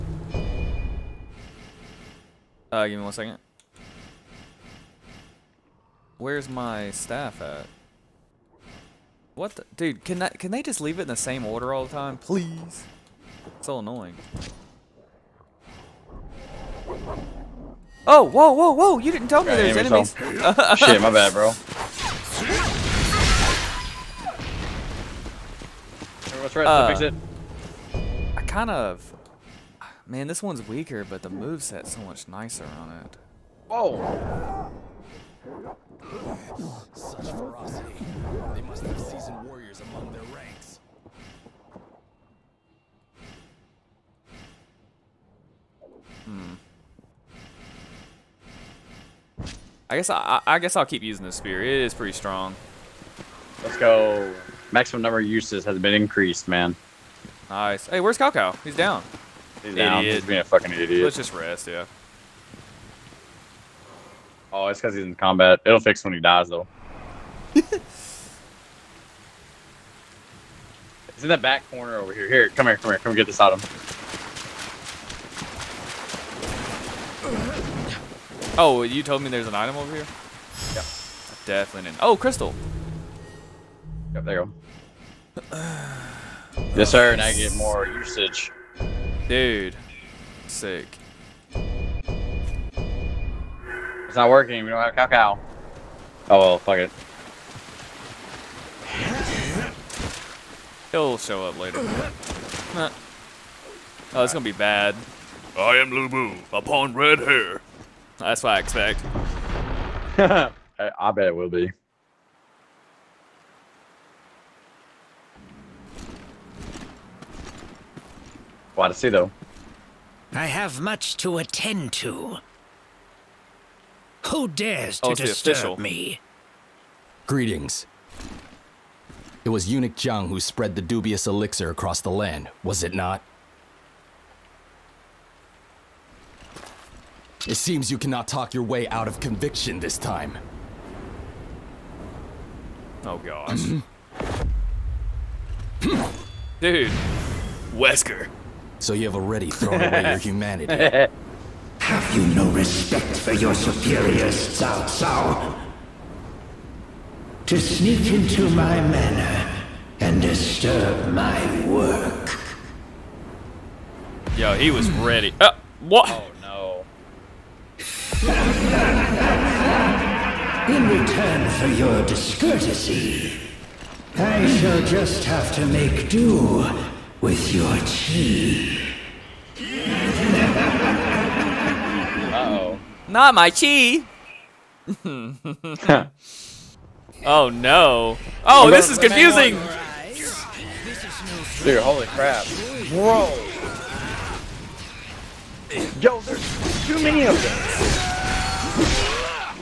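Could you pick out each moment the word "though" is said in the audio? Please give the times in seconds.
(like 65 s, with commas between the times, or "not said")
66 s, 119 s.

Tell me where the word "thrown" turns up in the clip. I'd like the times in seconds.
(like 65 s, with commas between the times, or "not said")
149 s.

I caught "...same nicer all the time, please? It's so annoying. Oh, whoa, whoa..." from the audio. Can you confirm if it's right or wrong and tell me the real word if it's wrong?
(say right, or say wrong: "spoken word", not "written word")
wrong: "order", not "nicer".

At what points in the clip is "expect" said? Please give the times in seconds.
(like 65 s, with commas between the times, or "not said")
108 s.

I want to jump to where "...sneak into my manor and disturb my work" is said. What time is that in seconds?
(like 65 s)
157 s.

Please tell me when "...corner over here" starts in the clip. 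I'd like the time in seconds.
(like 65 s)
71 s.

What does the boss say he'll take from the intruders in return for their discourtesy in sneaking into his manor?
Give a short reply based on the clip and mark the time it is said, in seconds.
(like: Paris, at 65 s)
Your chi, at 177 s.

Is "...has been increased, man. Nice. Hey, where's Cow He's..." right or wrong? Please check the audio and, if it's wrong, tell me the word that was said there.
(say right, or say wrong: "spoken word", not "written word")
right.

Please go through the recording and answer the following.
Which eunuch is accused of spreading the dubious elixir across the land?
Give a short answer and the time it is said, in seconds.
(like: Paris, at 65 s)
Zhang, at 129 s.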